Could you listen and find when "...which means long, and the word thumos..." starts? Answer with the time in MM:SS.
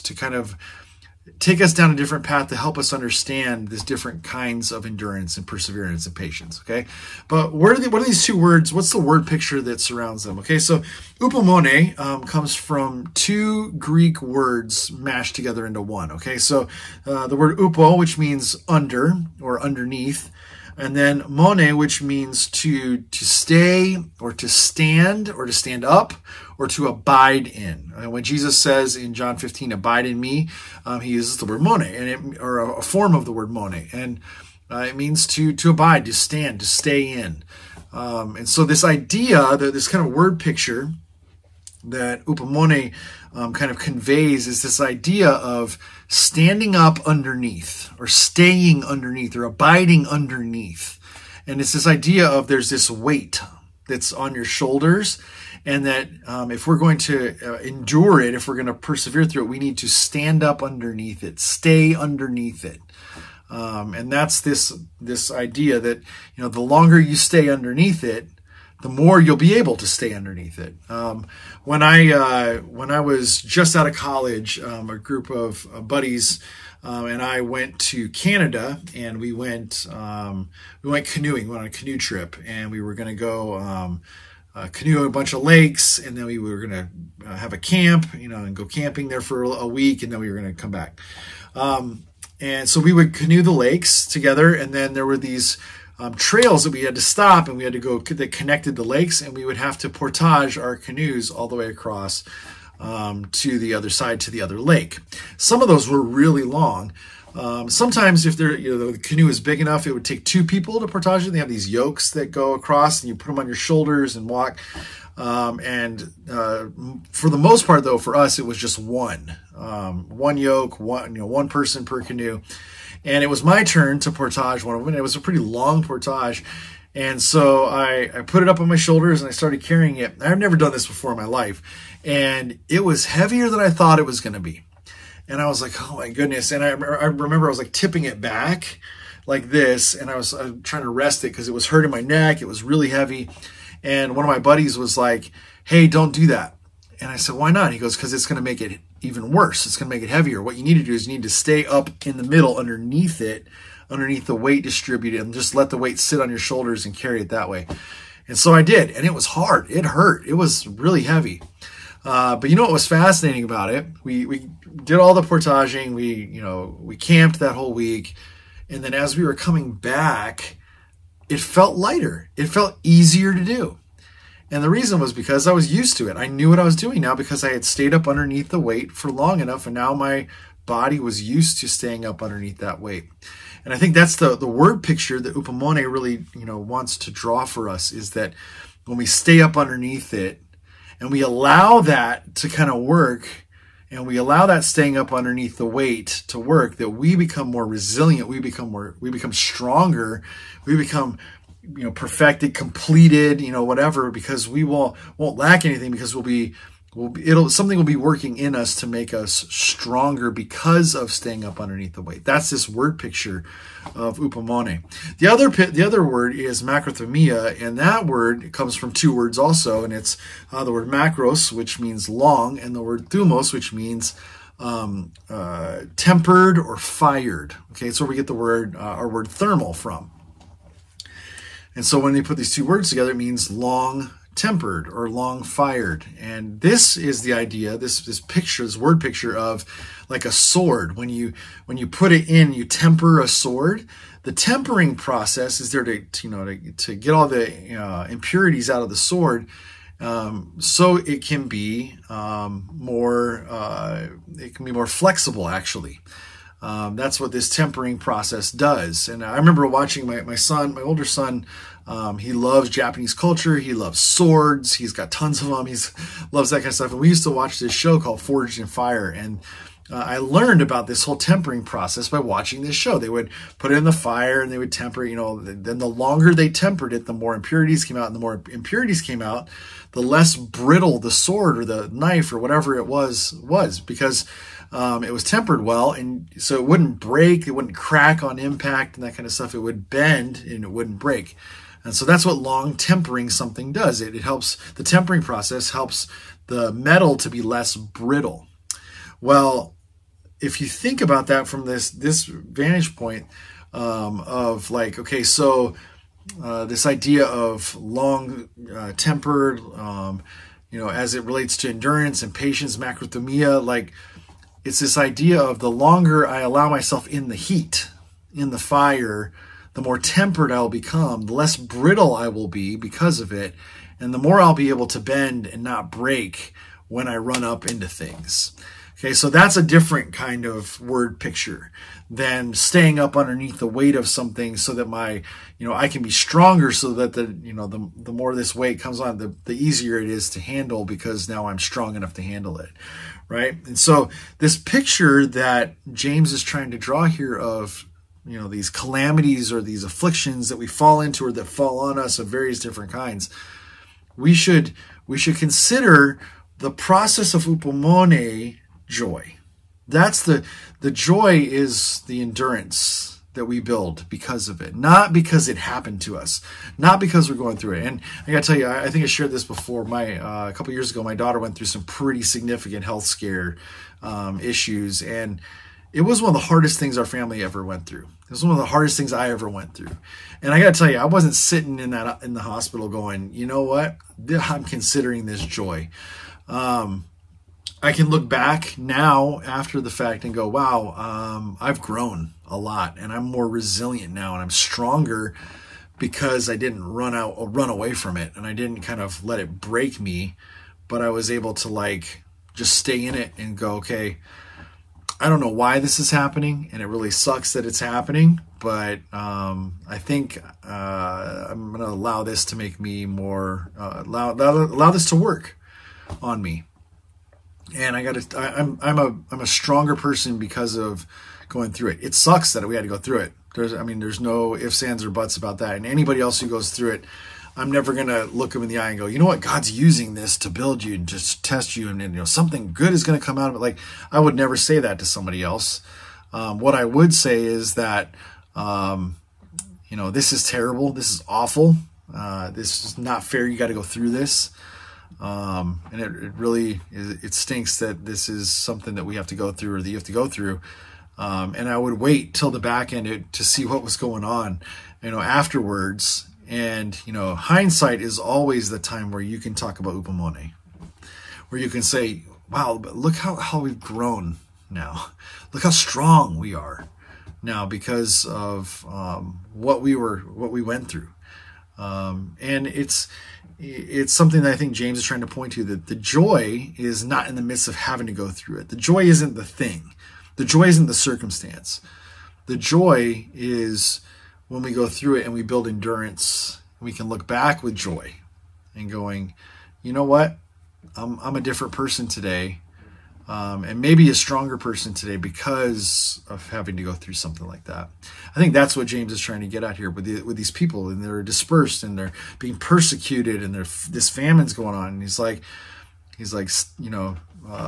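03:41.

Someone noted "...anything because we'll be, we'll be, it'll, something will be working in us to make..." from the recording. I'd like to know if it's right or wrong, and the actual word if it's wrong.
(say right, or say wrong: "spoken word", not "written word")
right.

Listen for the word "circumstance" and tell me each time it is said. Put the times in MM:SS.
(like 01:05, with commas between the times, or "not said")
08:00.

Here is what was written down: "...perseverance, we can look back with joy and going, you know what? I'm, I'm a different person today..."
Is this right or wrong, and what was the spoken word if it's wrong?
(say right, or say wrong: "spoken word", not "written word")
wrong: "endurance", not "perseverance".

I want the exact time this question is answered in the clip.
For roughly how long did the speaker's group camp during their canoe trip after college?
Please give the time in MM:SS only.
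01:29.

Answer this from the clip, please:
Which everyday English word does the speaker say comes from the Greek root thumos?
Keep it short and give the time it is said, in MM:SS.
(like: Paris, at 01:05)
Thermal, at 03:49.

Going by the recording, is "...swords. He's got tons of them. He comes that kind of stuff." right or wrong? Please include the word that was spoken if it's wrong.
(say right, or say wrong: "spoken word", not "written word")
wrong: "loves", not "comes".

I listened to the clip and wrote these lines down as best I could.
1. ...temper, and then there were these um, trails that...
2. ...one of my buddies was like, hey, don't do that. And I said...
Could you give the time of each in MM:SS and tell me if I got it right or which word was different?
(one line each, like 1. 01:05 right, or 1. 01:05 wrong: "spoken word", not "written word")
1. 01:34 wrong: "together", not "temper"
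2. 02:24 right.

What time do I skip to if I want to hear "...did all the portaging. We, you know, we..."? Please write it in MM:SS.
02:44.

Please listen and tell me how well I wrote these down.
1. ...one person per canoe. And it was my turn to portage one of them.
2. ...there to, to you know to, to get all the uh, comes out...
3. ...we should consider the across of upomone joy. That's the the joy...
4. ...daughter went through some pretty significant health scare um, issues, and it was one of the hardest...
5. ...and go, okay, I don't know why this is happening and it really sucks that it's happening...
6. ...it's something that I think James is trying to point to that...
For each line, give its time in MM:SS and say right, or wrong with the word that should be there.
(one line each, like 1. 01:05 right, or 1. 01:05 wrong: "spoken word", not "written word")
1. 02:01 right
2. 04:05 wrong: "impurities", not "comes"
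3. 05:55 wrong: "process", not "across"
4. 06:11 right
5. 06:43 right
6. 07:53 right.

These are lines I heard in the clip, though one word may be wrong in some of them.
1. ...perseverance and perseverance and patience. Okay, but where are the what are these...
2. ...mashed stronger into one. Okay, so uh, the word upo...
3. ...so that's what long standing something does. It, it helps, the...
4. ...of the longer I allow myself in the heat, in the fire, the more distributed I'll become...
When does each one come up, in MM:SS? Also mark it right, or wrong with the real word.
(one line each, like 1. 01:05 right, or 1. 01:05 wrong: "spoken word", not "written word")
1. 00:04 wrong: "endurance", not "perseverance"
2. 00:14 wrong: "together", not "stronger"
3. 04:51 wrong: "tempering", not "standing"
4. 05:15 wrong: "tempered", not "distributed".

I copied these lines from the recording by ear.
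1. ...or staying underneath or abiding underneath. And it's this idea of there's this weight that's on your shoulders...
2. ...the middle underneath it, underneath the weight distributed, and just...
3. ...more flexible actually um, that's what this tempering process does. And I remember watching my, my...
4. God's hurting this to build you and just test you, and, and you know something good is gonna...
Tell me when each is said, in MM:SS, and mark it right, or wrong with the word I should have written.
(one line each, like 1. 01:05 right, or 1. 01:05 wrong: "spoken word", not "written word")
1. 00:47 right
2. 02:32 right
3. 04:14 right
4. 07:09 wrong: "using", not "hurting".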